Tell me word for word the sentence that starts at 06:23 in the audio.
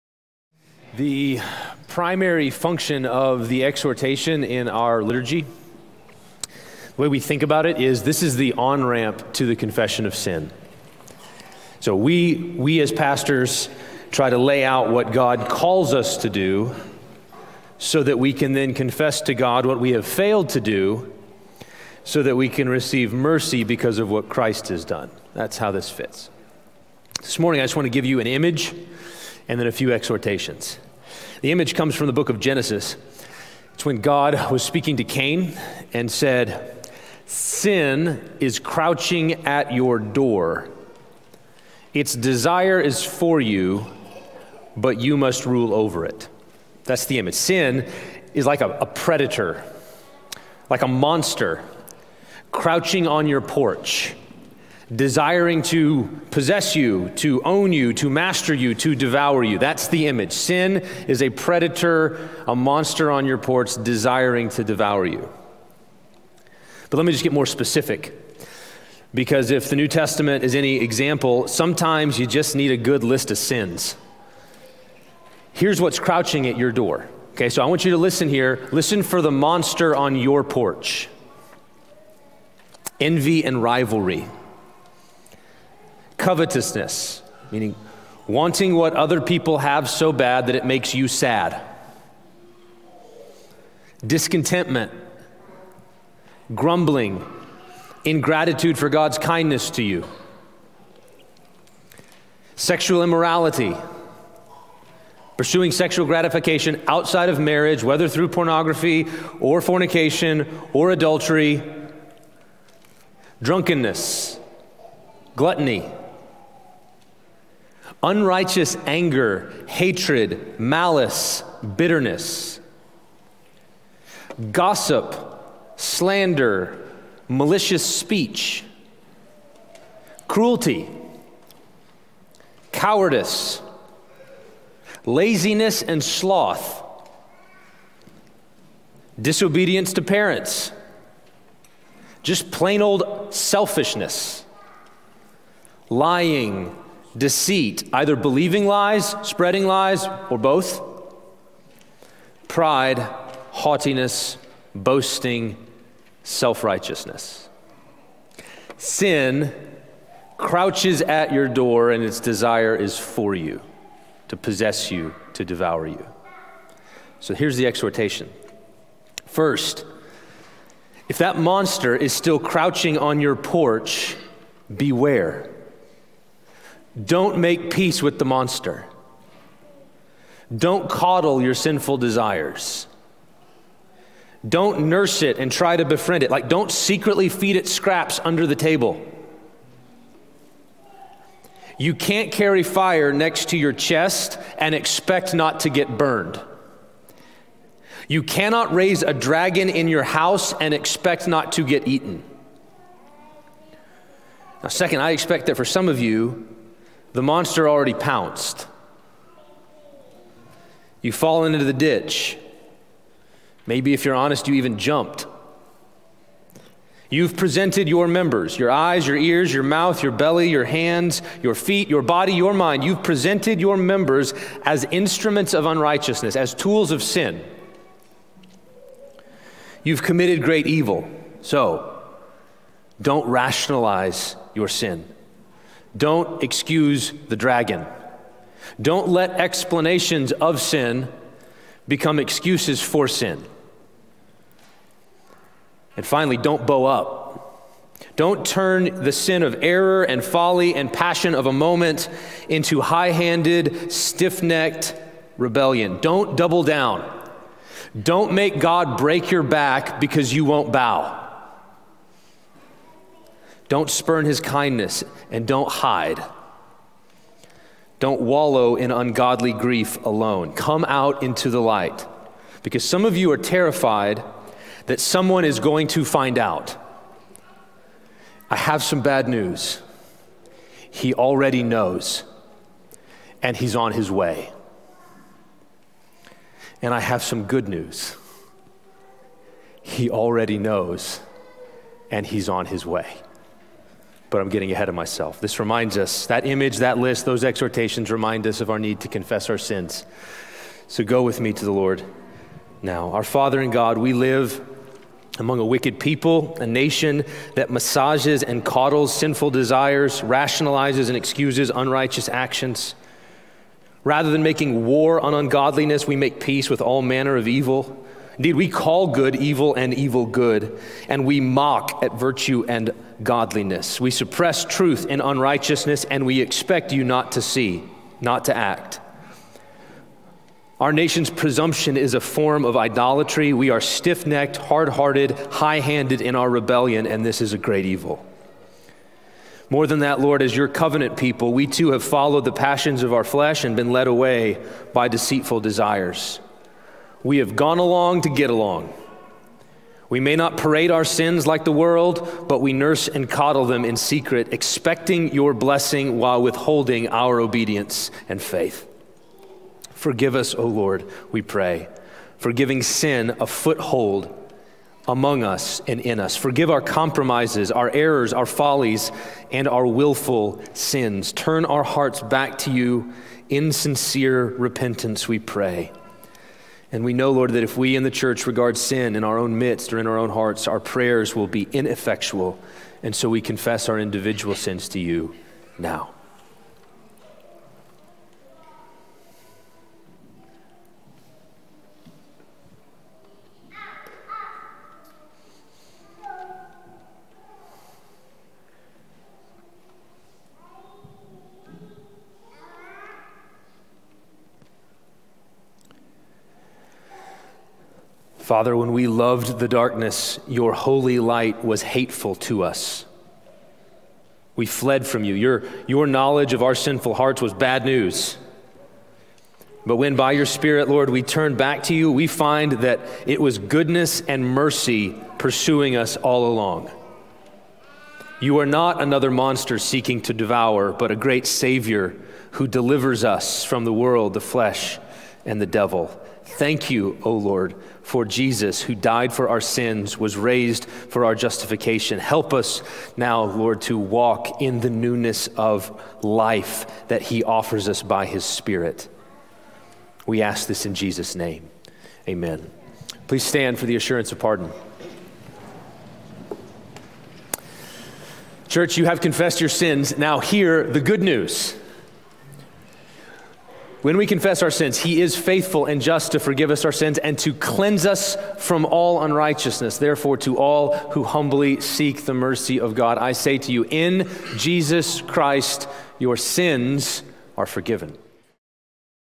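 And so we confess our individual sins to you now.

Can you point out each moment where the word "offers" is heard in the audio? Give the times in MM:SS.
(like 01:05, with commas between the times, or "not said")
07:27.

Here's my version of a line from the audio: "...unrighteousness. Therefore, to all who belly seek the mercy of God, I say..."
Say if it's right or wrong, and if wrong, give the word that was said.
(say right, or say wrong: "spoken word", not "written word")
wrong: "humbly", not "belly".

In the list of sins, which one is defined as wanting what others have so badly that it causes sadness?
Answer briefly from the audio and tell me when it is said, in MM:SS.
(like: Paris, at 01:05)
Covetousness, at 01:26.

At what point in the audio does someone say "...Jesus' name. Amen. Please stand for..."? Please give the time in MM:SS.
07:30.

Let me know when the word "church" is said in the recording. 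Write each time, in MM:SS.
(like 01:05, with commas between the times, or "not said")
06:18, 07:38.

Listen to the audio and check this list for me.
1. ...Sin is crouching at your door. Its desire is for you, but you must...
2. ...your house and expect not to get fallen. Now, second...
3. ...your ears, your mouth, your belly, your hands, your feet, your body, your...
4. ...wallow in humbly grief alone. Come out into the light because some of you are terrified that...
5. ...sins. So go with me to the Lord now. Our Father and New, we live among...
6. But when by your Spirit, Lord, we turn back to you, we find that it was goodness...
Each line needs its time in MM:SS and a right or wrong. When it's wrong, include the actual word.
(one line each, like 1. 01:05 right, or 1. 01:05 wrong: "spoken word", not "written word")
1. 00:37 right
2. 03:19 wrong: "eaten", not "fallen"
3. 03:39 right
4. 04:28 wrong: "ungodly", not "humbly"
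5. 04:59 wrong: "God", not "New"
6. 06:59 right.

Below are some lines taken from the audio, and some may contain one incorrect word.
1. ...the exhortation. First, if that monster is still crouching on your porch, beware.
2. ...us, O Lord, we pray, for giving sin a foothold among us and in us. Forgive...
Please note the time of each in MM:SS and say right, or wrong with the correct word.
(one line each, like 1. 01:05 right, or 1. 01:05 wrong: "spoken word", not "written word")
1. 02:47 right
2. 06:00 right.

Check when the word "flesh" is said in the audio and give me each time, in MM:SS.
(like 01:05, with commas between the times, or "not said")
05:43, 07:14.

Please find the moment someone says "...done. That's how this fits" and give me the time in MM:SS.
00:24.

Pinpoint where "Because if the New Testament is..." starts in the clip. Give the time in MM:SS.
01:09.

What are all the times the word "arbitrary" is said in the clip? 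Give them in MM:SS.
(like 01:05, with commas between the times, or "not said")
not said.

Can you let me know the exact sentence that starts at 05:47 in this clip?
We have gone along to get along.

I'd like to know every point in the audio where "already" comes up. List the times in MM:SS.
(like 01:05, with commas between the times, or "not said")
03:27, 04:41, 04:50.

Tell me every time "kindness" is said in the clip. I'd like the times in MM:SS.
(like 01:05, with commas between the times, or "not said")
01:39, 04:24.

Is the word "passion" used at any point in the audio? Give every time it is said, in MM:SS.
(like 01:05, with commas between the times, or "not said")
04:10, 05:42.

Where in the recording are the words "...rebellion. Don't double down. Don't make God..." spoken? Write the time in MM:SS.
04:15.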